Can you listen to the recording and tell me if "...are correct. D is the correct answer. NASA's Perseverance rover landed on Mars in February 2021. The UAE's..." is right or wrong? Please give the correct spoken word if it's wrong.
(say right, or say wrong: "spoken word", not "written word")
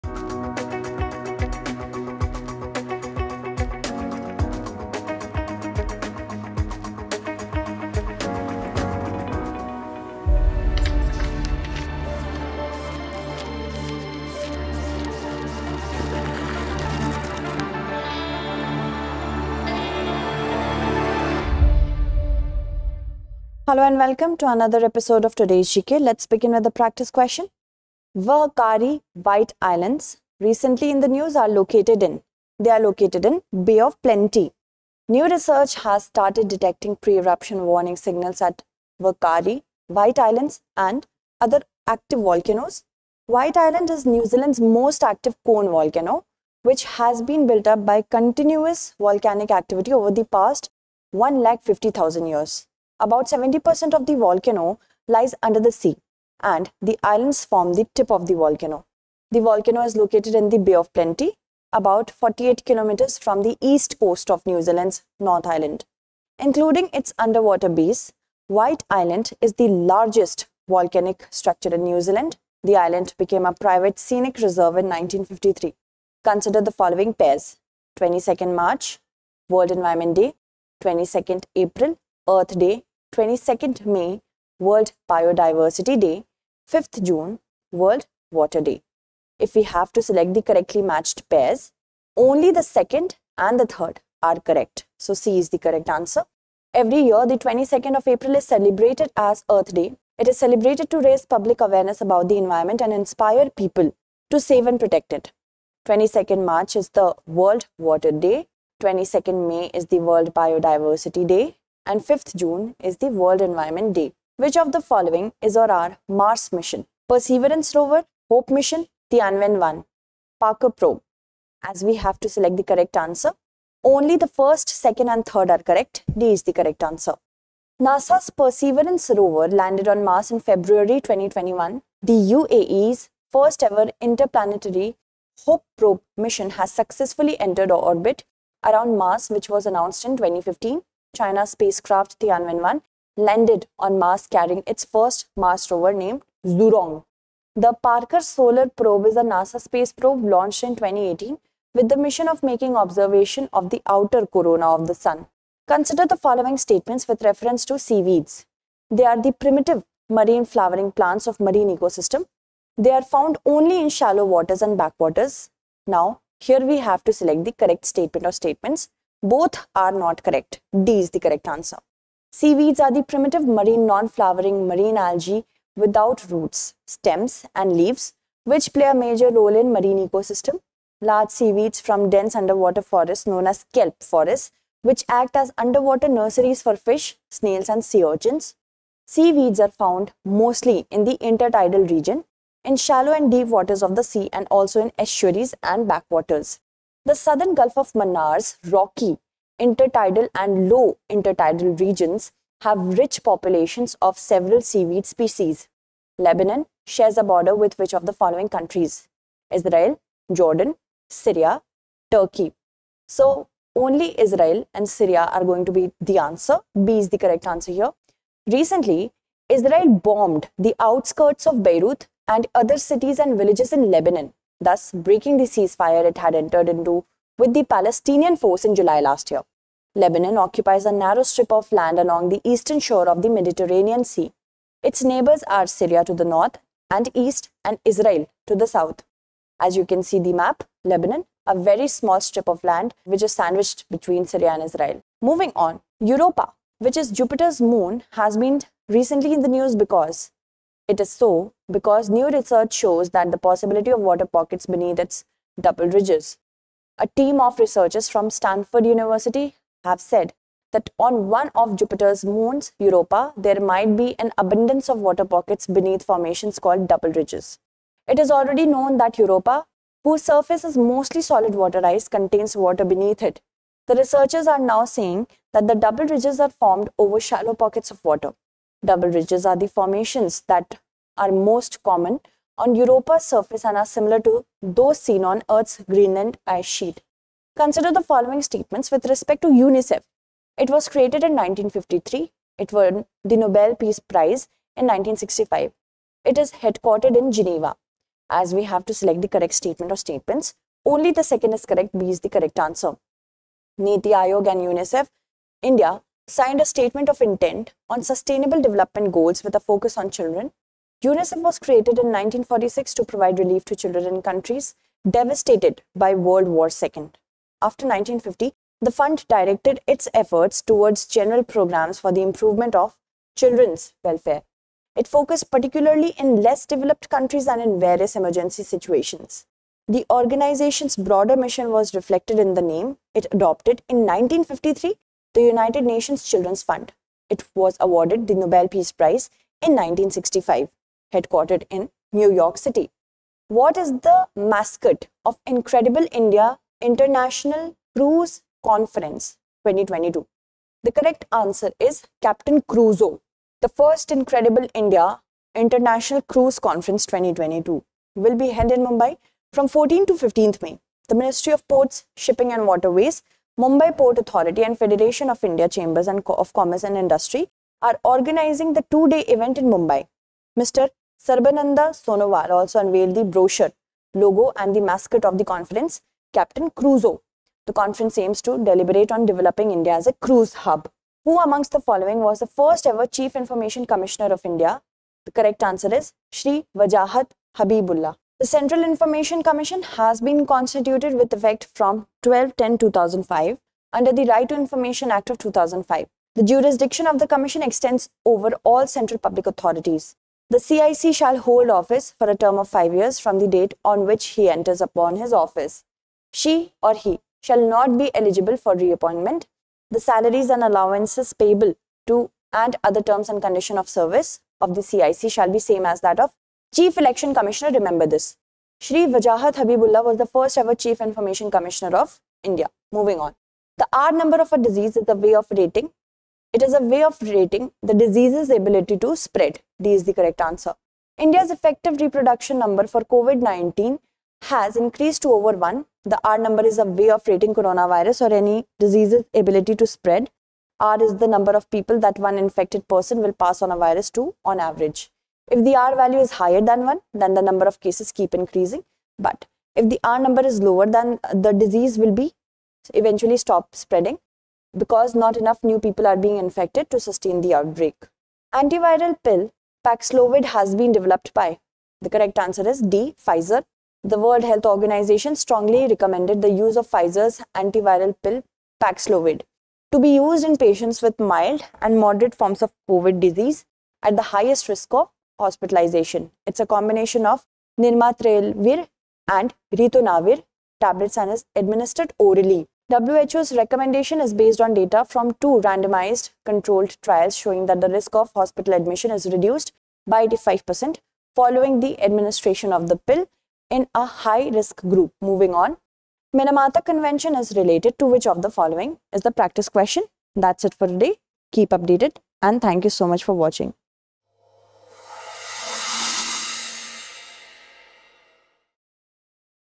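right.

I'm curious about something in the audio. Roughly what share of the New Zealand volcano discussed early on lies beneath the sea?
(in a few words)
70%.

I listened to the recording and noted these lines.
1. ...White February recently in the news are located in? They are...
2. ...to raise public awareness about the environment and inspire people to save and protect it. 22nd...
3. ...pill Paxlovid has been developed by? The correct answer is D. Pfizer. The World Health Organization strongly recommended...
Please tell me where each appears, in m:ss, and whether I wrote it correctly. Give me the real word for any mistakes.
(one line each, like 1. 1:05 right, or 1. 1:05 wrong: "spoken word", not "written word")
1. 0:29 wrong: "Islands", not "February"
2. 1:40 right
3. 7:39 right.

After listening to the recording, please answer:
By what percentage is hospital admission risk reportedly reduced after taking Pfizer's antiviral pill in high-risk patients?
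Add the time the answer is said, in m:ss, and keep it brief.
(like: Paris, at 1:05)
85%, at 8:10.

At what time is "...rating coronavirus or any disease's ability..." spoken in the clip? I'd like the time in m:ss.
7:17.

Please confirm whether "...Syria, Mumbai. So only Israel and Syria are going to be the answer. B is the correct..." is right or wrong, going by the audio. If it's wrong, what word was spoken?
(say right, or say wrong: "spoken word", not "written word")
wrong: "Turkey", not "Mumbai".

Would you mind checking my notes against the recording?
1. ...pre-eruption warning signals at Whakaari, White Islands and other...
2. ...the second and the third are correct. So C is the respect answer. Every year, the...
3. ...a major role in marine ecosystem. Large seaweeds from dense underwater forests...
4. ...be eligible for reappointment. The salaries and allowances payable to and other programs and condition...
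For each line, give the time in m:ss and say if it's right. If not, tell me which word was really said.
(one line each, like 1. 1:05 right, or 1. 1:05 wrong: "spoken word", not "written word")
1. 0:36 right
2. 1:32 wrong: "correct", not "respect"
3. 2:58 right
4. 6:47 wrong: "terms", not "programs".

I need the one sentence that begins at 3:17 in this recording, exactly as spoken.
The southern Gulf of Mannar's rocky, intertidal and low intertidal regions have rich populations of several seaweed species.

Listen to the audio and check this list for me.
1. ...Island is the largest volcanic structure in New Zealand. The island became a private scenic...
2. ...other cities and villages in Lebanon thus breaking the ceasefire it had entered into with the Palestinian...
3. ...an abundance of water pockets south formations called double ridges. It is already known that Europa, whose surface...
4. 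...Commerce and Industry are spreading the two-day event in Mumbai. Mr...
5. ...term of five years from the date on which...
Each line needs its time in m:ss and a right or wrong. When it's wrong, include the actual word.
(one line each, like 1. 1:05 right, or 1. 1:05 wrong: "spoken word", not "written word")
1. 1:08 right
2. 3:42 right
3. 4:24 wrong: "beneath", not "south"
4. 6:06 wrong: "organizing", not "spreading"
5. 6:42 right.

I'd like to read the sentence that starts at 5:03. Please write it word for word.
Niti Aayog and UNICEF India signed a statement of intent on sustainable development goals with a focus on children.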